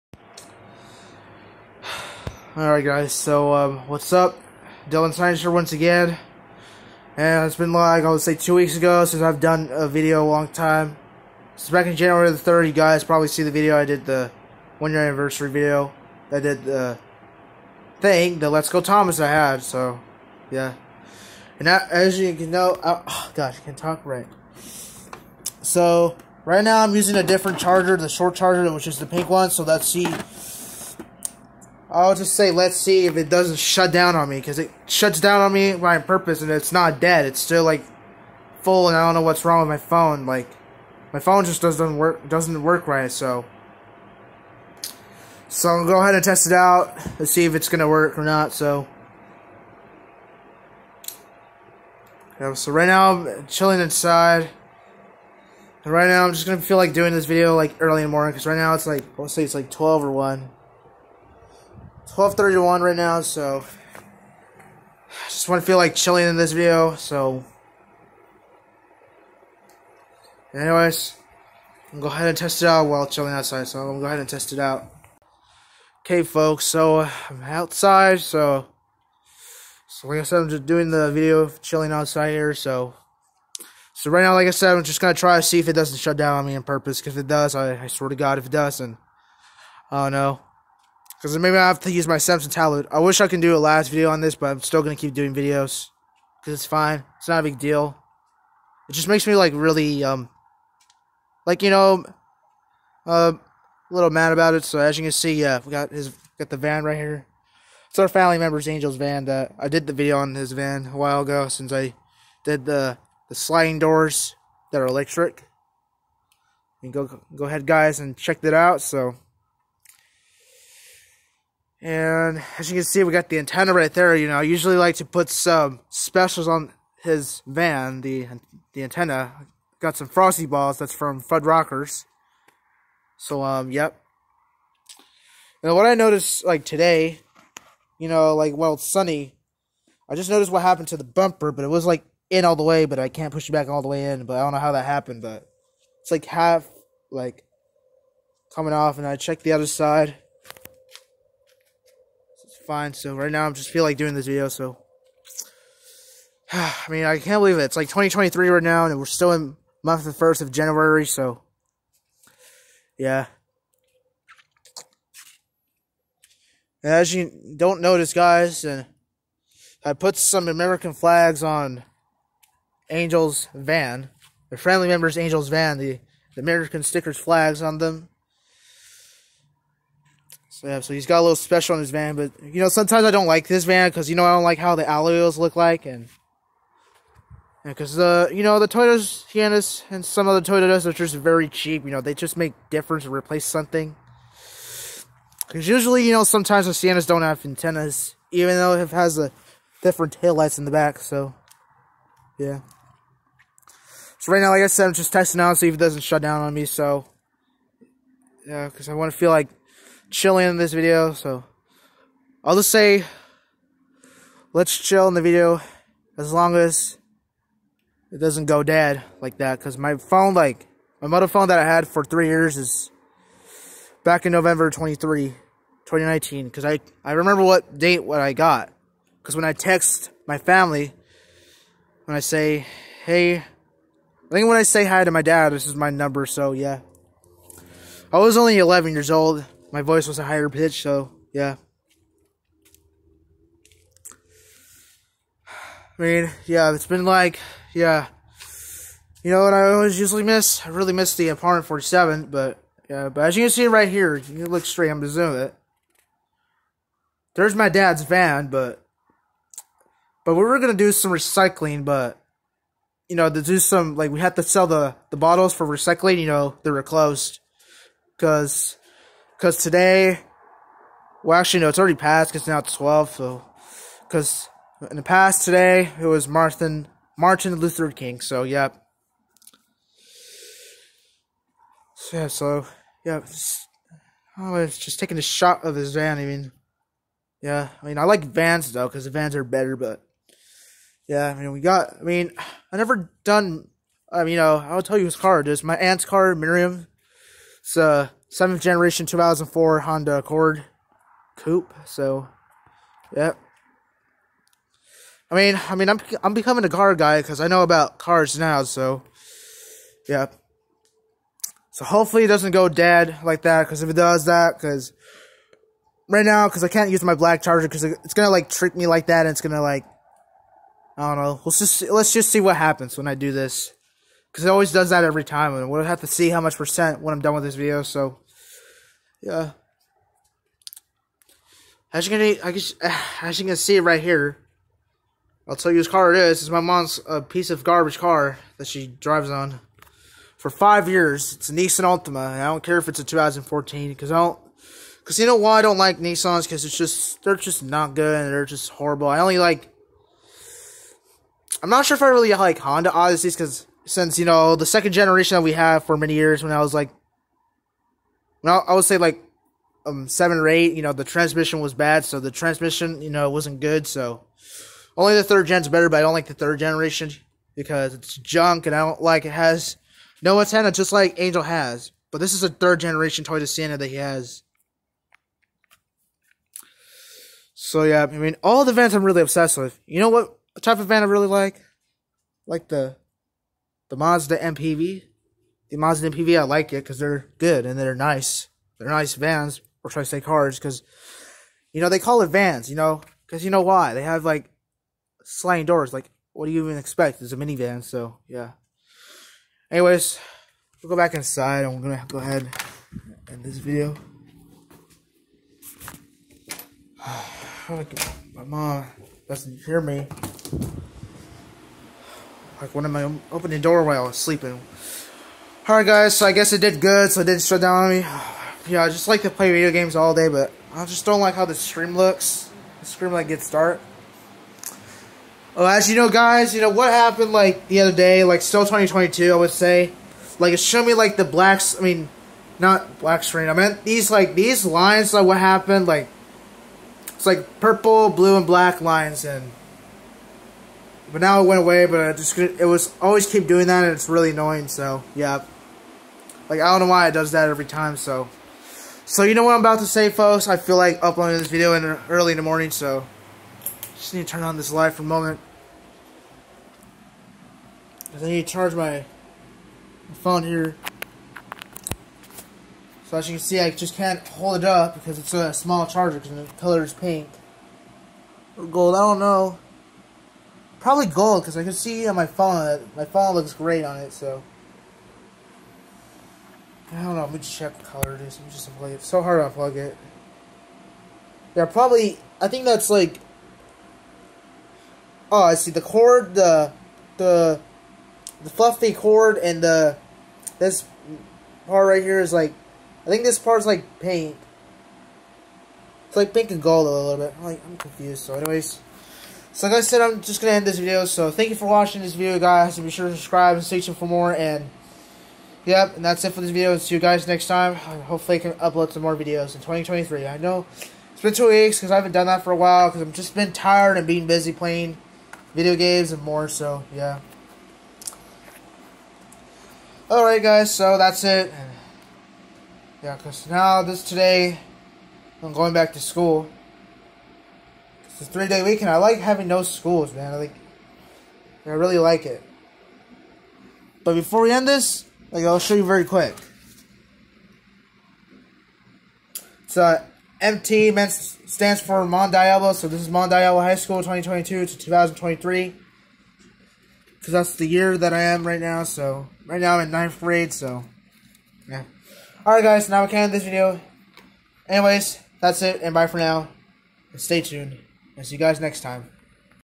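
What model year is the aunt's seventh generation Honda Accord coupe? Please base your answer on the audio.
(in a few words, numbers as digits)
2004.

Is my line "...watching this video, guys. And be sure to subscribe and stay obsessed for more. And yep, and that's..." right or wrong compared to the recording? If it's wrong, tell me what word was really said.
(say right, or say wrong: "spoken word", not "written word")
wrong: "tuned", not "obsessed".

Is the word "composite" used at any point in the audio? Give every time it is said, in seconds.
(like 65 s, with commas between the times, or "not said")
not said.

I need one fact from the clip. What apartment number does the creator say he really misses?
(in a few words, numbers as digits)
47.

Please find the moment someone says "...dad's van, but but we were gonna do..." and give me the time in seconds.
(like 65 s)
257 s.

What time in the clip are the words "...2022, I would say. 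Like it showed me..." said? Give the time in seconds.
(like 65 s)
428 s.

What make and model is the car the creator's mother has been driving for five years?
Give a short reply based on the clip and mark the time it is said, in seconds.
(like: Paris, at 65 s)
Nissan Altima, at 341 s.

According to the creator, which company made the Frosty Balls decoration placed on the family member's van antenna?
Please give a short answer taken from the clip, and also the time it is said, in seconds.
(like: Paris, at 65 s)
Fud Rockers, at 131 s.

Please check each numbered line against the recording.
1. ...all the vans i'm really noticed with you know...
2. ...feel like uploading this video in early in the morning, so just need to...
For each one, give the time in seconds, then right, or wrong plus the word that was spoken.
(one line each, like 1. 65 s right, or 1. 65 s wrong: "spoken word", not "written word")
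1. 378 s wrong: "obsessed", not "noticed"
2. 450 s right.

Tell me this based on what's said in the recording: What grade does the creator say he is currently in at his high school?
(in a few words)
ninth grade.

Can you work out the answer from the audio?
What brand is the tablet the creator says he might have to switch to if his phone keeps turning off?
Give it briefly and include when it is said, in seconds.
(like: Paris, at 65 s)
Samsung, at 92 s.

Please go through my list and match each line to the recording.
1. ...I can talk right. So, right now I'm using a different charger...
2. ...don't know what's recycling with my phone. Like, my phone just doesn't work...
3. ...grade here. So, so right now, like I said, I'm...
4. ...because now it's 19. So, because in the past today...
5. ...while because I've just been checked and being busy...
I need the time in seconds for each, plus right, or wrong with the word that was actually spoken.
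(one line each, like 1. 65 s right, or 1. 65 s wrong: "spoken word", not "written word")
1. 23 s right
2. 39 s wrong: "wrong", not "recycling"
3. 81 s wrong: "outside", not "grade"
4. 272 s wrong: "12", not "19"
5. 512 s wrong: "tired", not "checked".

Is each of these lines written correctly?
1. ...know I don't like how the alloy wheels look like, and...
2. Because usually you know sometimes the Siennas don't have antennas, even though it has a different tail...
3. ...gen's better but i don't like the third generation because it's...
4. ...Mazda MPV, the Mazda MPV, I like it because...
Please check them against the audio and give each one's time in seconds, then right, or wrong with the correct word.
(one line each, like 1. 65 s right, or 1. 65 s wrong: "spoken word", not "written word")
1. 184 s right
2. 195 s right
3. 365 s right
4. 383 s right.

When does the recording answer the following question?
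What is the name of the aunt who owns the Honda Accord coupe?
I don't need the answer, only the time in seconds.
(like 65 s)
296 s.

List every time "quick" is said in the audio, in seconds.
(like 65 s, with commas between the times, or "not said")
536 s.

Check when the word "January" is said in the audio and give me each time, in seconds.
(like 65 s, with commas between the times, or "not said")
11 s, 160 s.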